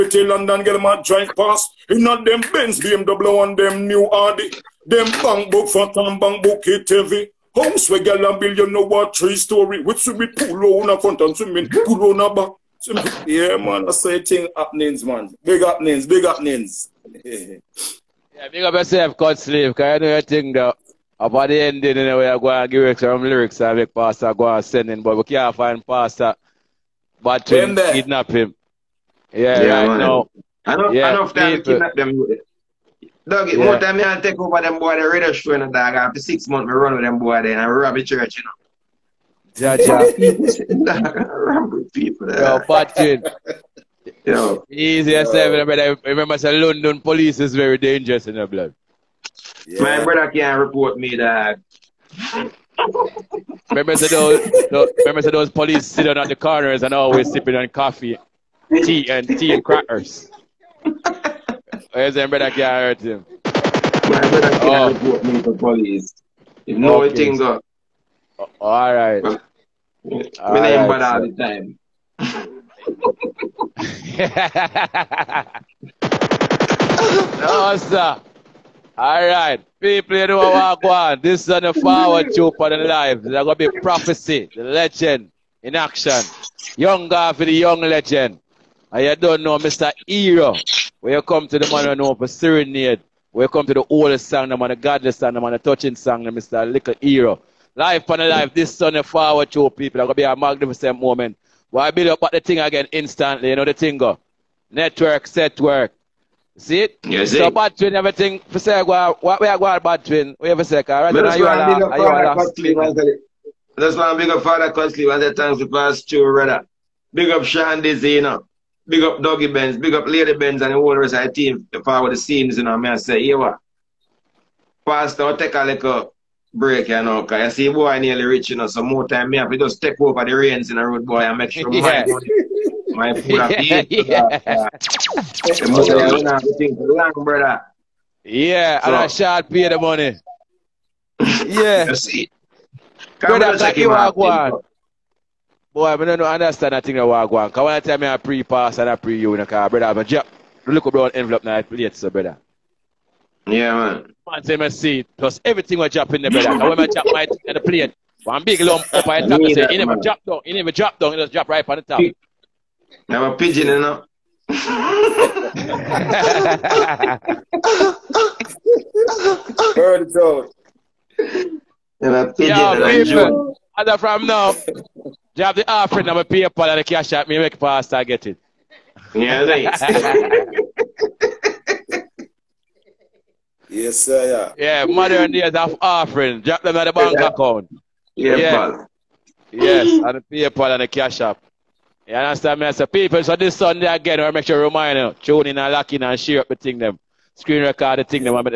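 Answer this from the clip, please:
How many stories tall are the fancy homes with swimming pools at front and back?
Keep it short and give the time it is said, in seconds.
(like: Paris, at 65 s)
3, at 9 s.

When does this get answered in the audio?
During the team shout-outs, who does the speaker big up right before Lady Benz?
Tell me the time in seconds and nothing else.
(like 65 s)
119 s.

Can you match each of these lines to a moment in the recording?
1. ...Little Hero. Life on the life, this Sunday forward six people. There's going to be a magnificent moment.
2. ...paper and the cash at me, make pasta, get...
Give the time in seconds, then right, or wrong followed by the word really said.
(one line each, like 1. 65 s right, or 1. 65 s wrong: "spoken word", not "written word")
1. 96 s wrong: "two", not "six"
2. 176 s right.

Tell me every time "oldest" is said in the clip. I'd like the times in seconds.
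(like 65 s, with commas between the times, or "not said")
93 s.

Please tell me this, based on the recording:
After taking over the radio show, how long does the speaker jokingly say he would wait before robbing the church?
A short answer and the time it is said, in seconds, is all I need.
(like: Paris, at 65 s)
6 months, at 36 s.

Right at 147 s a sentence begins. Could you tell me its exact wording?
Because when I tell me I pre-pass and I pre-you, you know, because brother, I have a job.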